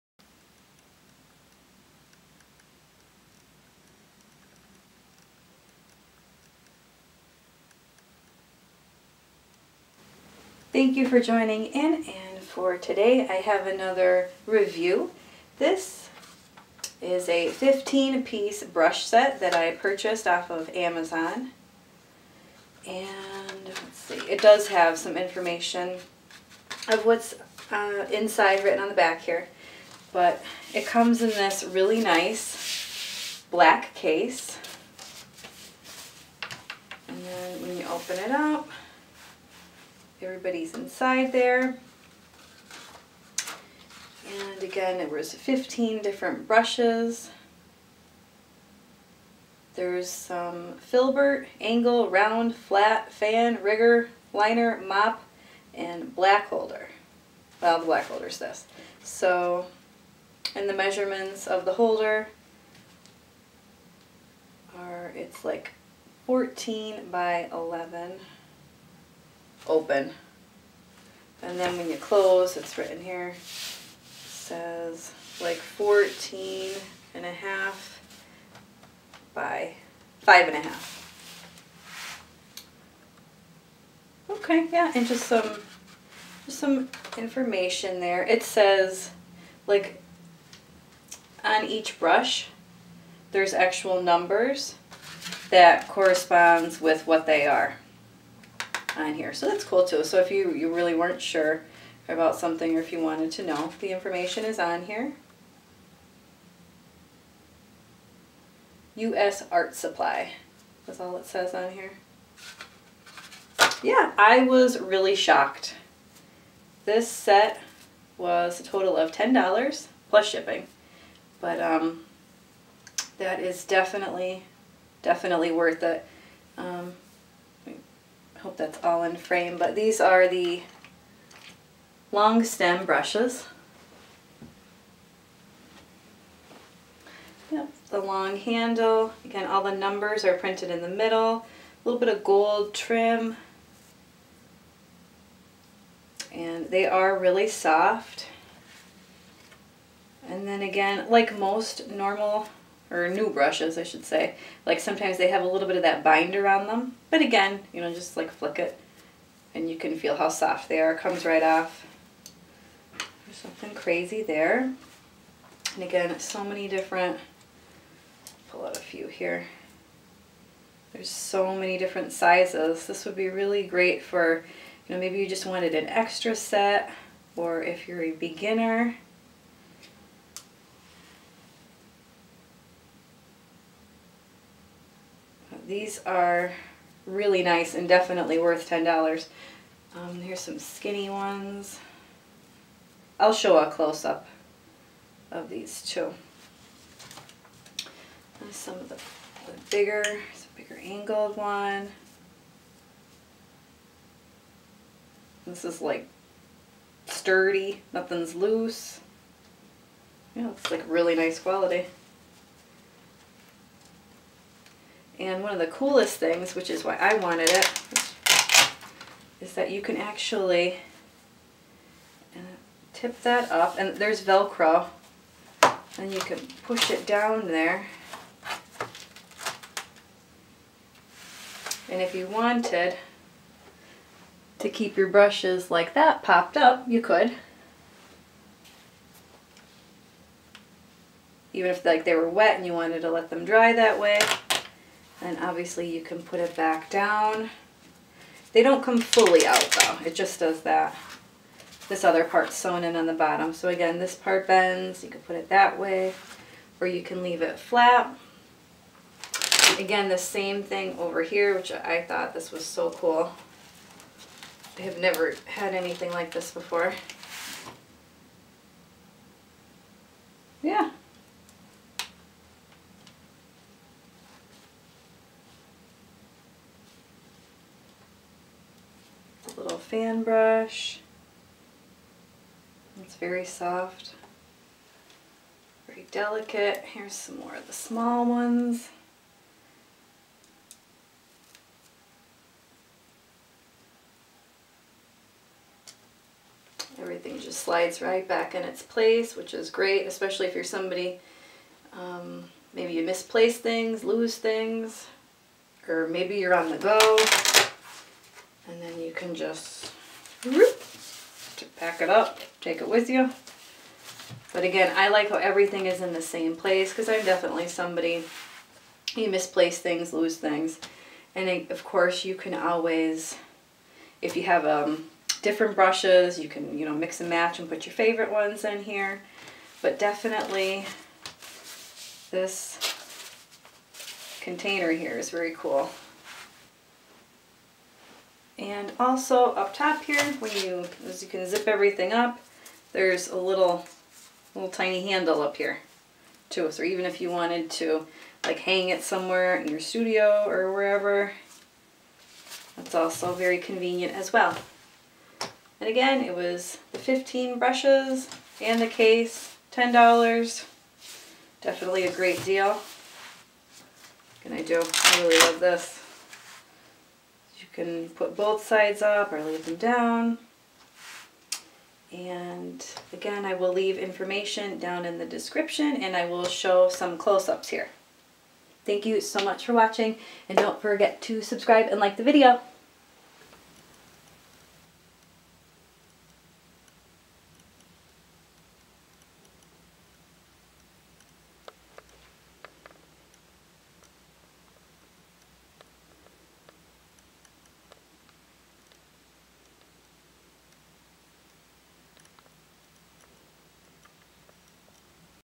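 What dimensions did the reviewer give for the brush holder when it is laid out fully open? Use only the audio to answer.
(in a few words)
14 by 11.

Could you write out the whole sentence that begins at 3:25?
This is like sturdy, nothing's loose.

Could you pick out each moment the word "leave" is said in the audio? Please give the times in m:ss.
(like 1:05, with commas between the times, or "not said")
4:17, 6:09, 6:13.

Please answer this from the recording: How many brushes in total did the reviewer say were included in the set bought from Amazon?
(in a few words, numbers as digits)
15.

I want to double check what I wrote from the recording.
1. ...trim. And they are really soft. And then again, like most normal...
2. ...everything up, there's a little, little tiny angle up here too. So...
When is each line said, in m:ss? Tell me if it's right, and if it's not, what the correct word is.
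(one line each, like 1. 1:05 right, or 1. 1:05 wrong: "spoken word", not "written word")
1. 2:22 right
2. 5:41 wrong: "handle", not "angle".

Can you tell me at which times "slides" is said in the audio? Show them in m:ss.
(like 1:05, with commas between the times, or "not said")
4:57.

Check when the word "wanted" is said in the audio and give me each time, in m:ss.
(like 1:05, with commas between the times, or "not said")
1:42, 2:55, 3:37, 3:52, 4:02, 5:47.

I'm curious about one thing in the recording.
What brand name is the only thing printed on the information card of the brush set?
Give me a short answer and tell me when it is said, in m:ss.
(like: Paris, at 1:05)
U.S. Art Supply, at 1:48.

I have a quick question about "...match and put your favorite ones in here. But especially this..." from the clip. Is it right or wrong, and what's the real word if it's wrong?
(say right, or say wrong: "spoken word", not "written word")
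wrong: "definitely", not "especially".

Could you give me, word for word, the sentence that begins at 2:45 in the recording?
And again, so many different, pull out a few here.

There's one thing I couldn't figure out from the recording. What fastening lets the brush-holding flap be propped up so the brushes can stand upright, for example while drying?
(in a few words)
Velcro.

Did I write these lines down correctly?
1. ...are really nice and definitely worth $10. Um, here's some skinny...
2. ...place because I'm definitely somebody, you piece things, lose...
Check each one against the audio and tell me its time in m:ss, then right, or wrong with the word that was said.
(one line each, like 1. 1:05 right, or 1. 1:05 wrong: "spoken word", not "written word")
1. 3:06 right
2. 5:16 wrong: "misplace", not "piece".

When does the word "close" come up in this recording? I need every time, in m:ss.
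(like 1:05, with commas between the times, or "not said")
1:11, 3:13, 6:17.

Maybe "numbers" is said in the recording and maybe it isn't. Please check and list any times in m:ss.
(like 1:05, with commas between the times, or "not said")
1:34, 2:19.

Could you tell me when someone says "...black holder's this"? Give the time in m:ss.
0:57.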